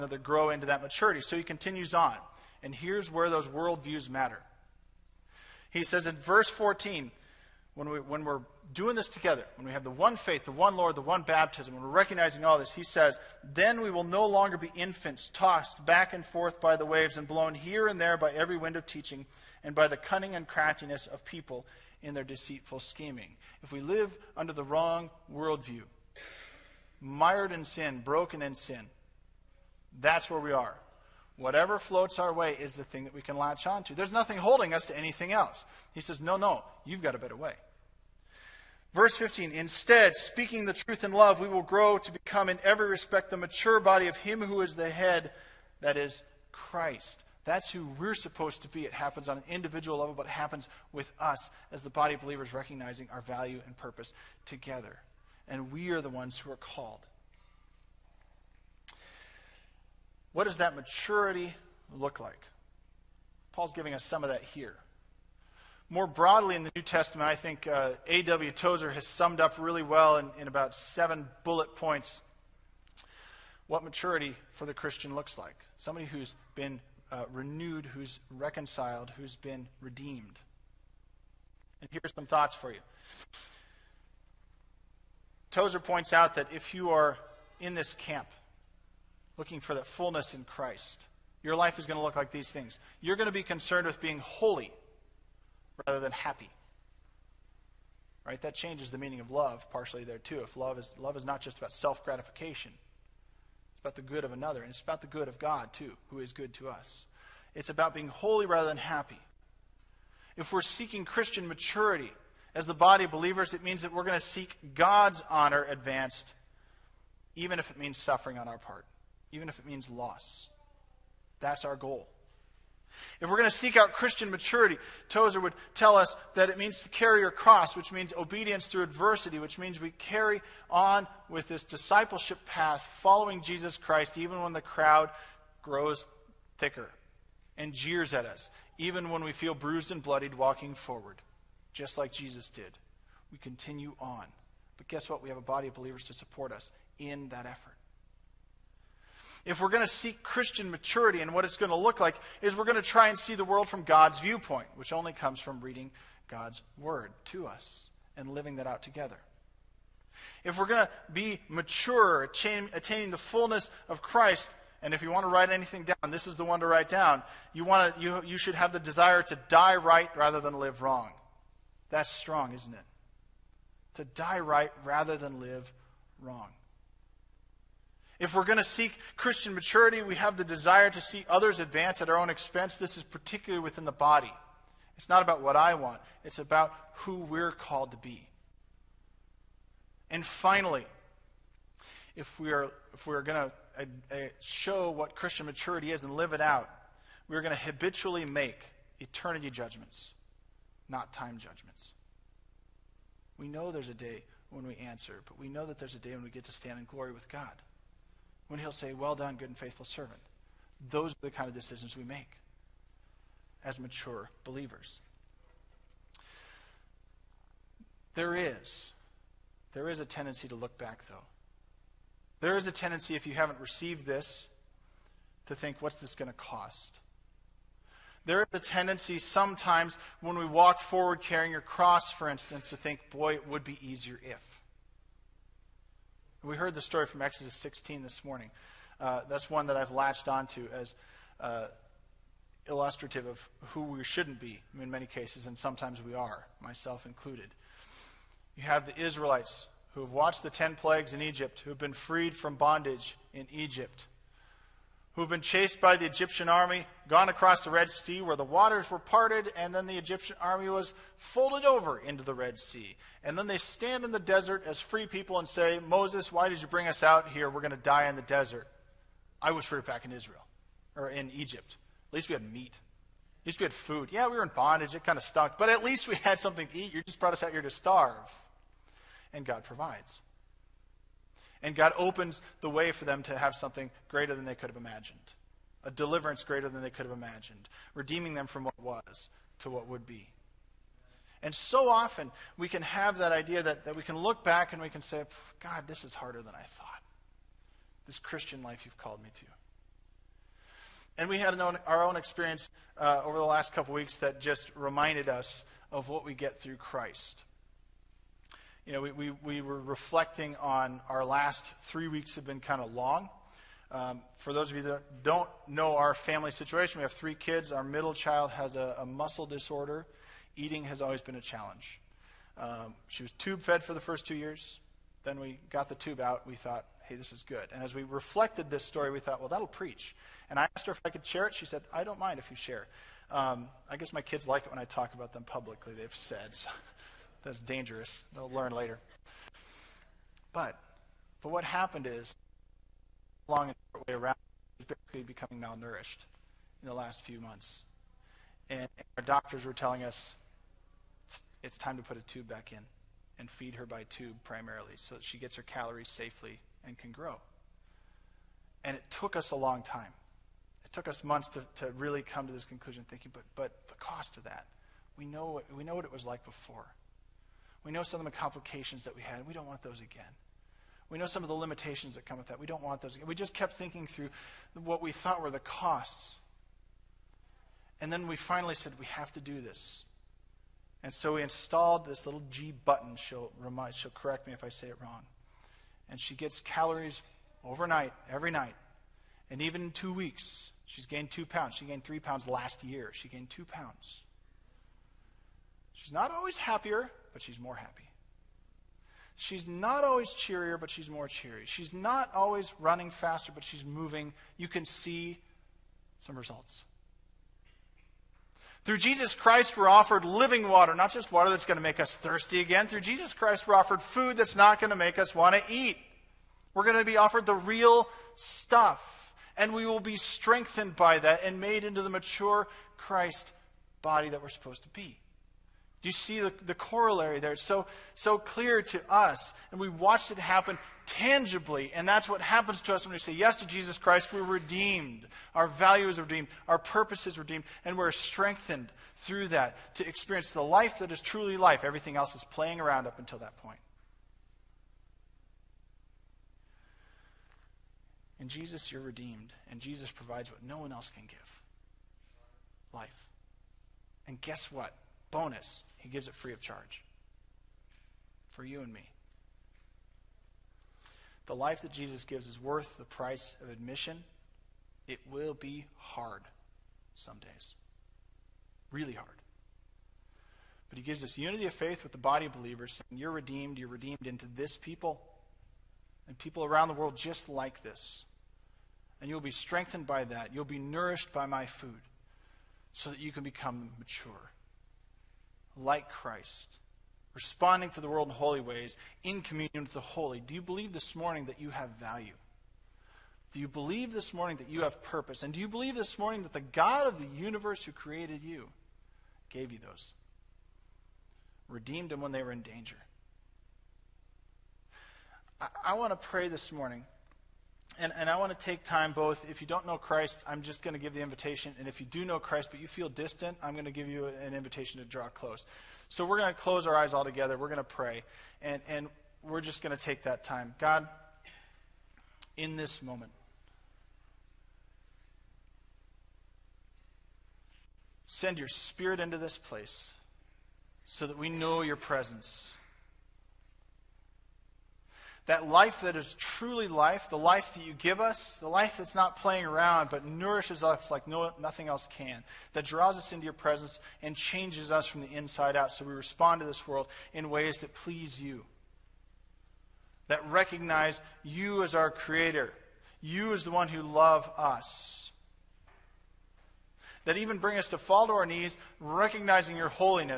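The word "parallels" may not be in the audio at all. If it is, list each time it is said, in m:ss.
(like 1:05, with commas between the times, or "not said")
not said.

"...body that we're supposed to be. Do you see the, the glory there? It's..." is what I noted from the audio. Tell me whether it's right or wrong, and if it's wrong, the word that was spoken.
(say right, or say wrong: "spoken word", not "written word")
wrong: "corollary", not "glory".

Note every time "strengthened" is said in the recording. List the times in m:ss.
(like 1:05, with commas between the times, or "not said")
7:00, 7:18, 7:59.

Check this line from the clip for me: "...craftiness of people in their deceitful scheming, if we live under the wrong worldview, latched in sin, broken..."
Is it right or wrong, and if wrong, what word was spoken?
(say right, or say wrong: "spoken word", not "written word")
wrong: "mired", not "latched".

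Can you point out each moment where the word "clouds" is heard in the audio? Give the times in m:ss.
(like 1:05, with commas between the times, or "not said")
not said.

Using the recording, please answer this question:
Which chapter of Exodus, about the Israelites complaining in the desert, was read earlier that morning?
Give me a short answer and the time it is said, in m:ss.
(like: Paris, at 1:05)
Exodus 16, at 3:57.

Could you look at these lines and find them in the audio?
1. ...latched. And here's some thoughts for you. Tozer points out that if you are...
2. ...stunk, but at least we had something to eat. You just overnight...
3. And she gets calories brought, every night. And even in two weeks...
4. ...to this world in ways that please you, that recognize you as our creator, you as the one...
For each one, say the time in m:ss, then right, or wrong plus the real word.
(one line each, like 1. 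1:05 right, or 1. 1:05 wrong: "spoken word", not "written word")
1. 1:19 wrong: "redeemed", not "latched"
2. 4:35 wrong: "brought", not "overnight"
3. 6:26 wrong: "overnight", not "brought"
4. 9:06 right.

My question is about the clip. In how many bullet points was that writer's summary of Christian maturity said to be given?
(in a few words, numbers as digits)
7.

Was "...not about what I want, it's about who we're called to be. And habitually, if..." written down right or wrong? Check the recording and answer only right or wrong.
wrong.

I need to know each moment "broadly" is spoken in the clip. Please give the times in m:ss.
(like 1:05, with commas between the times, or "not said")
1:06.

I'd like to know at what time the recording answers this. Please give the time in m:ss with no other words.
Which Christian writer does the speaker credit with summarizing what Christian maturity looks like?
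1:08.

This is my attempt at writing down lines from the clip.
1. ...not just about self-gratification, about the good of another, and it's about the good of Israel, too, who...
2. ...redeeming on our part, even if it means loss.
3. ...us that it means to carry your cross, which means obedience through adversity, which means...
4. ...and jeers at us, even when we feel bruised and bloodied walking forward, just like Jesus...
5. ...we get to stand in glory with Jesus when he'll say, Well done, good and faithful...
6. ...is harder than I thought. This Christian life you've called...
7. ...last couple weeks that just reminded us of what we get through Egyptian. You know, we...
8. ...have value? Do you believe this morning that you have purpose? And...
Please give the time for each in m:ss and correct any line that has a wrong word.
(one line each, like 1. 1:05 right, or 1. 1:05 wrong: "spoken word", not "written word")
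1. 1:41 wrong: "God", not "Israel"
2. 1:57 wrong: "suffering", not "redeeming"
3. 2:05 right
4. 2:17 right
5. 3:26 wrong: "God", not "Jesus"
6. 4:56 right
7. 5:03 wrong: "Christ", not "Egyptian"
8. 8:11 right.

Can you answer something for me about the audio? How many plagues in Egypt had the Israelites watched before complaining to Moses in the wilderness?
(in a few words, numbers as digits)
10.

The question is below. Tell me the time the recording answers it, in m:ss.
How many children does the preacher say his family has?
5:17.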